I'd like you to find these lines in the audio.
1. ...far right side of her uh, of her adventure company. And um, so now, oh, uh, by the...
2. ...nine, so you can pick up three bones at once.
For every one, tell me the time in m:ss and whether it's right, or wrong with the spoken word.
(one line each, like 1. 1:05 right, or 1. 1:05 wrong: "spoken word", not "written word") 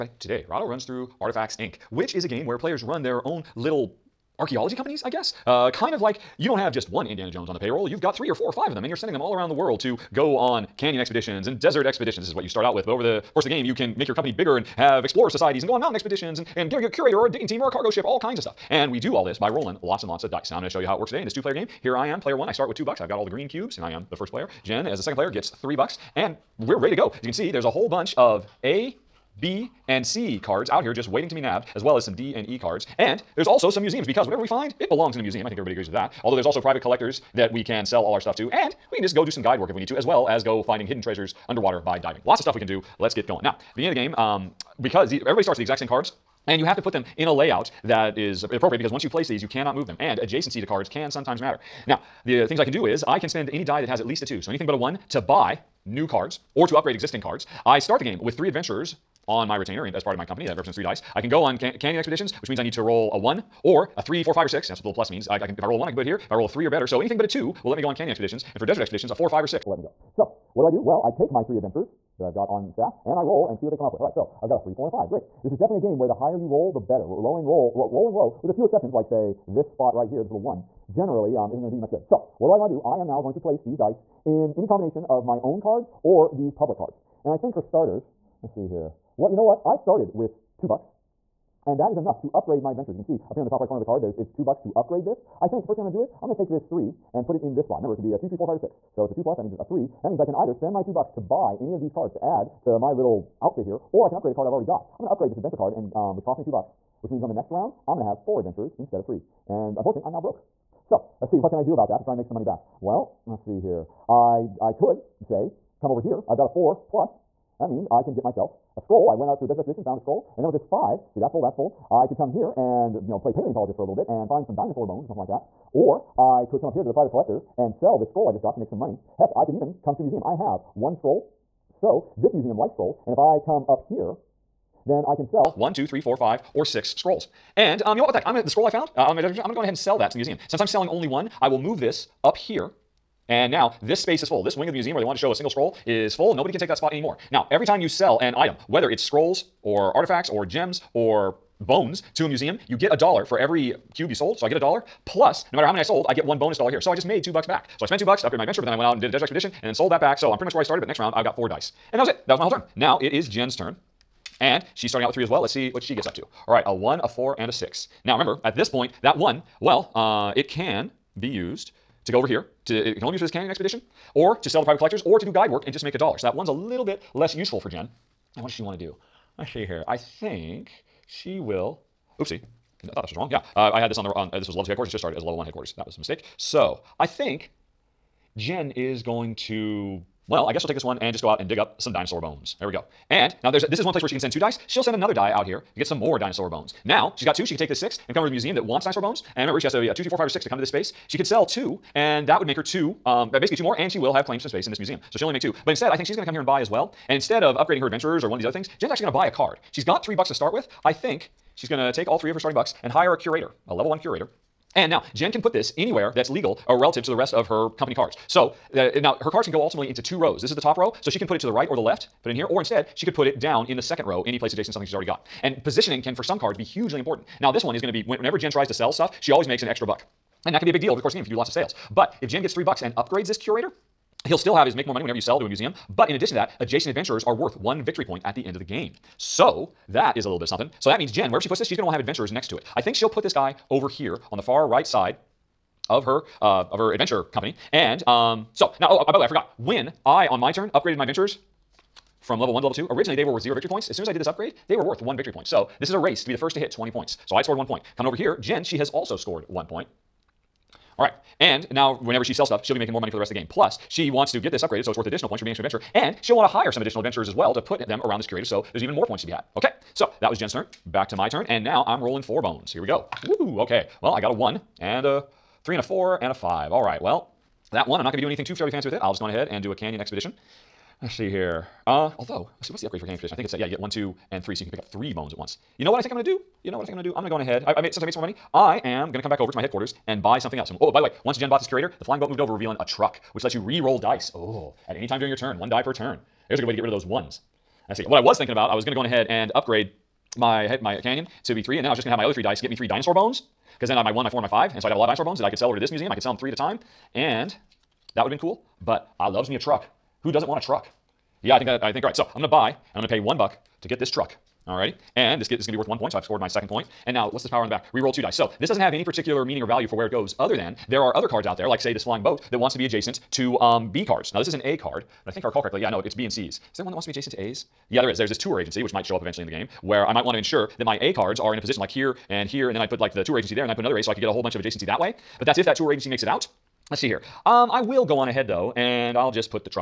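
1. 4:04 right
2. 4:44 wrong: "three", not "nine".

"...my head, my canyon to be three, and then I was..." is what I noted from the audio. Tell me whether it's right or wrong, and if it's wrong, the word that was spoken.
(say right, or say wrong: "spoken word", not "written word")
right.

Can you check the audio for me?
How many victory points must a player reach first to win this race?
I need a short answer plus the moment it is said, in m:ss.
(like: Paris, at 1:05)
20, at 4:16.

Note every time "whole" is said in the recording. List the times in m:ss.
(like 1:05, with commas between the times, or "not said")
0:27, 2:42, 5:34.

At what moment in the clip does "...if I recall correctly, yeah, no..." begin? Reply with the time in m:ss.
5:25.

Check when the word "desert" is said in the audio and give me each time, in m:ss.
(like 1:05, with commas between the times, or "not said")
0:11, 1:08, 1:59, 2:19, 2:39.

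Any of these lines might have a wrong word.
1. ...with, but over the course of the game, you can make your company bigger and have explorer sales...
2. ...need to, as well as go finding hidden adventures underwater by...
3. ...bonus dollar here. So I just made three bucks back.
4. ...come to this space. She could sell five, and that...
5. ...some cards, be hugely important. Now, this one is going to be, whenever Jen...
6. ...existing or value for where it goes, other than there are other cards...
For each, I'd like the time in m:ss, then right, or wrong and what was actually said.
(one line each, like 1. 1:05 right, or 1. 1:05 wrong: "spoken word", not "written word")
1. 0:12 wrong: "societies", not "sales"
2. 0:39 wrong: "treasures", not "adventures"
3. 2:36 wrong: "two", not "three"
4. 3:20 wrong: "two", not "five"
5. 3:46 right
6. 5:19 wrong: "meaning", not "existing".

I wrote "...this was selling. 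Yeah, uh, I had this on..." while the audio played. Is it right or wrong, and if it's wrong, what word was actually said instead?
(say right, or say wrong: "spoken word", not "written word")
wrong: "wrong", not "selling".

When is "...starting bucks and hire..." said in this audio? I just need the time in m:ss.
3:32.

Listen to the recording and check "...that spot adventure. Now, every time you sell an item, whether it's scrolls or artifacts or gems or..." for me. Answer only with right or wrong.
wrong.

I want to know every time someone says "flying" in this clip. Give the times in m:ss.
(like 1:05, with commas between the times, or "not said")
4:52, 5:22.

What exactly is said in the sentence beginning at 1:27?
And I think for starters, Let's see here.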